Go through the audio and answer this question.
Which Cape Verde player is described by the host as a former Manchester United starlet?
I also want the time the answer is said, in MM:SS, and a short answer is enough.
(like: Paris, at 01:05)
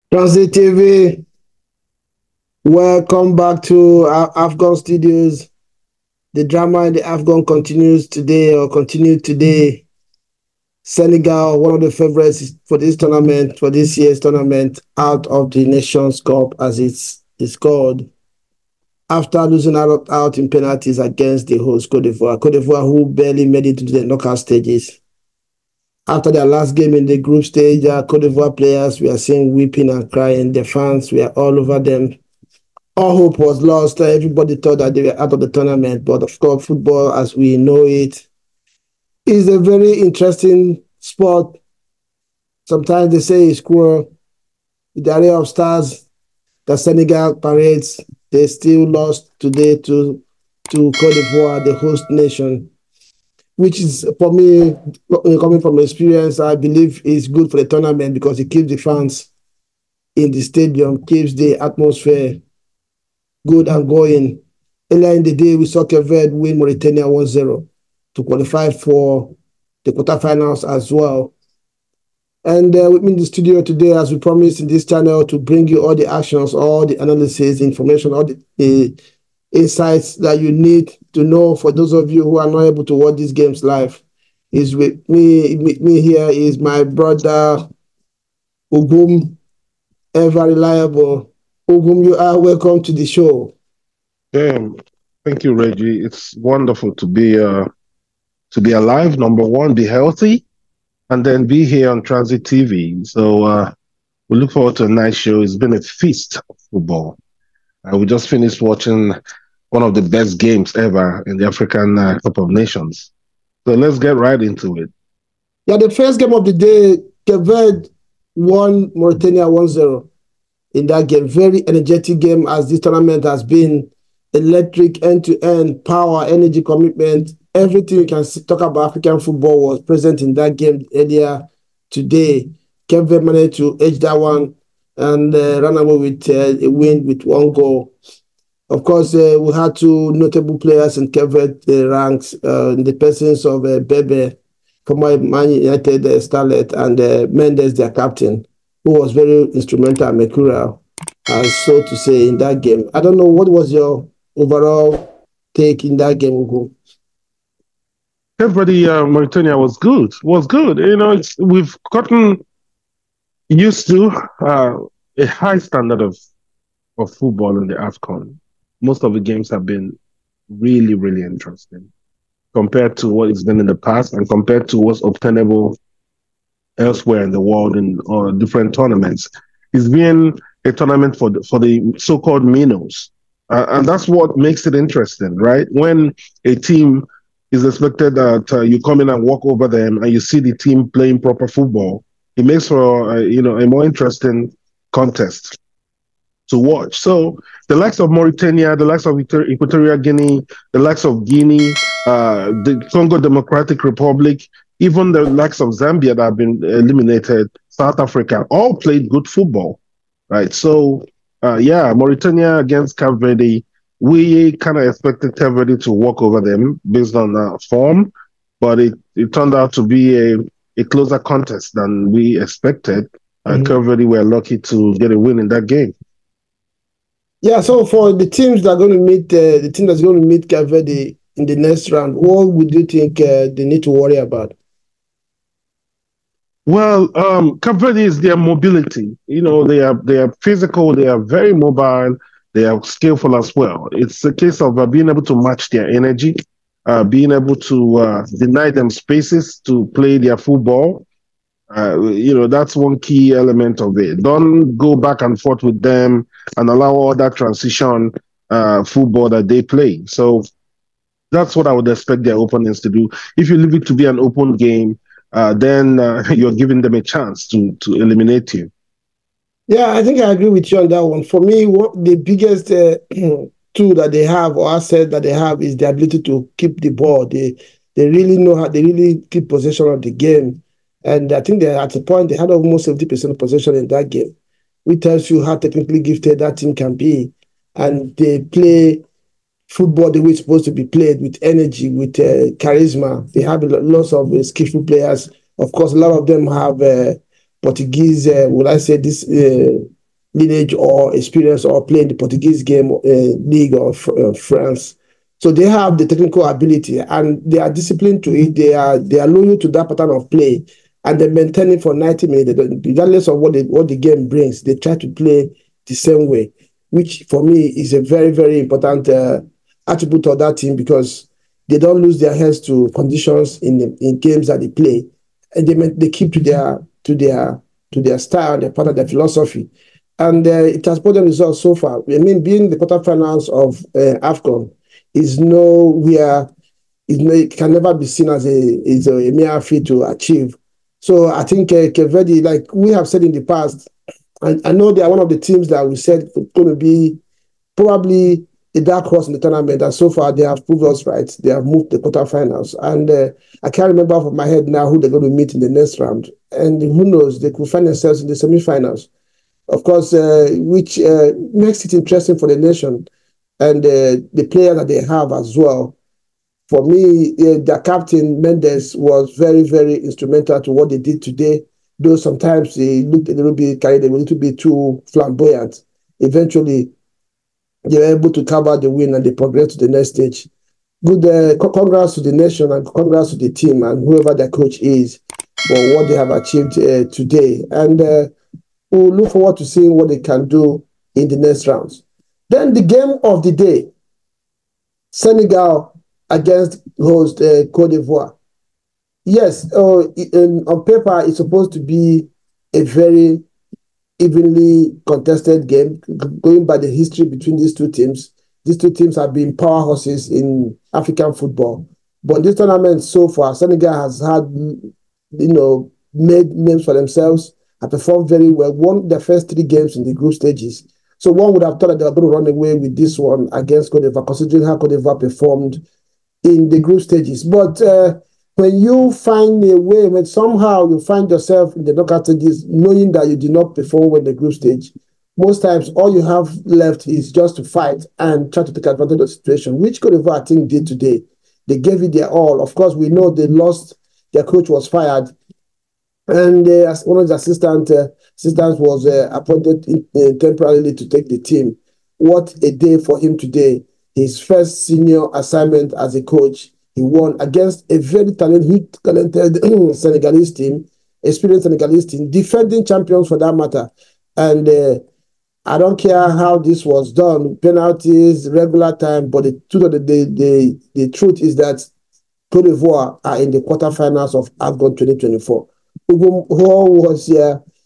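Bebe, at 02:23.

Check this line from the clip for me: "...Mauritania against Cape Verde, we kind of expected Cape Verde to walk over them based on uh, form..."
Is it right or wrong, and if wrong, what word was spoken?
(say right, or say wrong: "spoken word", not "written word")
right.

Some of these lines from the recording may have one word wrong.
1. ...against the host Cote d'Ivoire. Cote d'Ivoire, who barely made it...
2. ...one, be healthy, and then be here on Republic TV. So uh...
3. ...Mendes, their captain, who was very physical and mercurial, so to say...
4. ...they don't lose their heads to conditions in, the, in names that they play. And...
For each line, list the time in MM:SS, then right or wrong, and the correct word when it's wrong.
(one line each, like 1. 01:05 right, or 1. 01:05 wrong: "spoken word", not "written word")
1. 00:20 right
2. 01:39 wrong: "Tranzeet", not "Republic"
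3. 02:27 wrong: "instrumental", not "physical"
4. 05:21 wrong: "games", not "names".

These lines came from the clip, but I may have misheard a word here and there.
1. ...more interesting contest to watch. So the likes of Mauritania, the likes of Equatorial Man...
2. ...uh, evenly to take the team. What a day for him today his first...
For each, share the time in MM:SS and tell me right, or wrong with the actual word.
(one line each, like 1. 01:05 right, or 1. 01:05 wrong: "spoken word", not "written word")
1. 03:13 wrong: "Guinea", not "Man"
2. 07:30 wrong: "temporarily", not "evenly".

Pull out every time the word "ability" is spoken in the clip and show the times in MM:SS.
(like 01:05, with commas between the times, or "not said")
04:35, 05:06.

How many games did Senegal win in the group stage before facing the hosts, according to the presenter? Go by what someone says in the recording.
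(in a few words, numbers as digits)
3.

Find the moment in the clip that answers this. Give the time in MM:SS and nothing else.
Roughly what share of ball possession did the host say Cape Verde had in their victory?
04:42.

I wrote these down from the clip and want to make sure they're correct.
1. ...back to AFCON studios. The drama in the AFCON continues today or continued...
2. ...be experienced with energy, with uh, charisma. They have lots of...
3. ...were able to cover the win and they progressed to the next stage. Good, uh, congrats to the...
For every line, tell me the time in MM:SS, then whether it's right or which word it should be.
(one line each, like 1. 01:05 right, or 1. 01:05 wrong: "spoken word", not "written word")
1. 00:03 right
2. 04:50 wrong: "played", not "experienced"
3. 06:17 right.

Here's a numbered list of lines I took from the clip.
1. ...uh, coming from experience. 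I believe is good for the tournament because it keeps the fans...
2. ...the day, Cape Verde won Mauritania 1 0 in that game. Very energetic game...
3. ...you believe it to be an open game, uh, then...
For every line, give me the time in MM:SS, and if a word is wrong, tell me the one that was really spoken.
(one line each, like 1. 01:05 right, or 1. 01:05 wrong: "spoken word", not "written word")
1. 00:55 right
2. 01:56 right
3. 04:23 wrong: "leave", not "believe".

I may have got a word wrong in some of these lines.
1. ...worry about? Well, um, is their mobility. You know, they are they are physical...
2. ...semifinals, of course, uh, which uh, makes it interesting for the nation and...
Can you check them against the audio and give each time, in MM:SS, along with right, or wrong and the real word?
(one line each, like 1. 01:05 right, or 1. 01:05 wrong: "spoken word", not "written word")
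1. 03:53 right
2. 05:58 right.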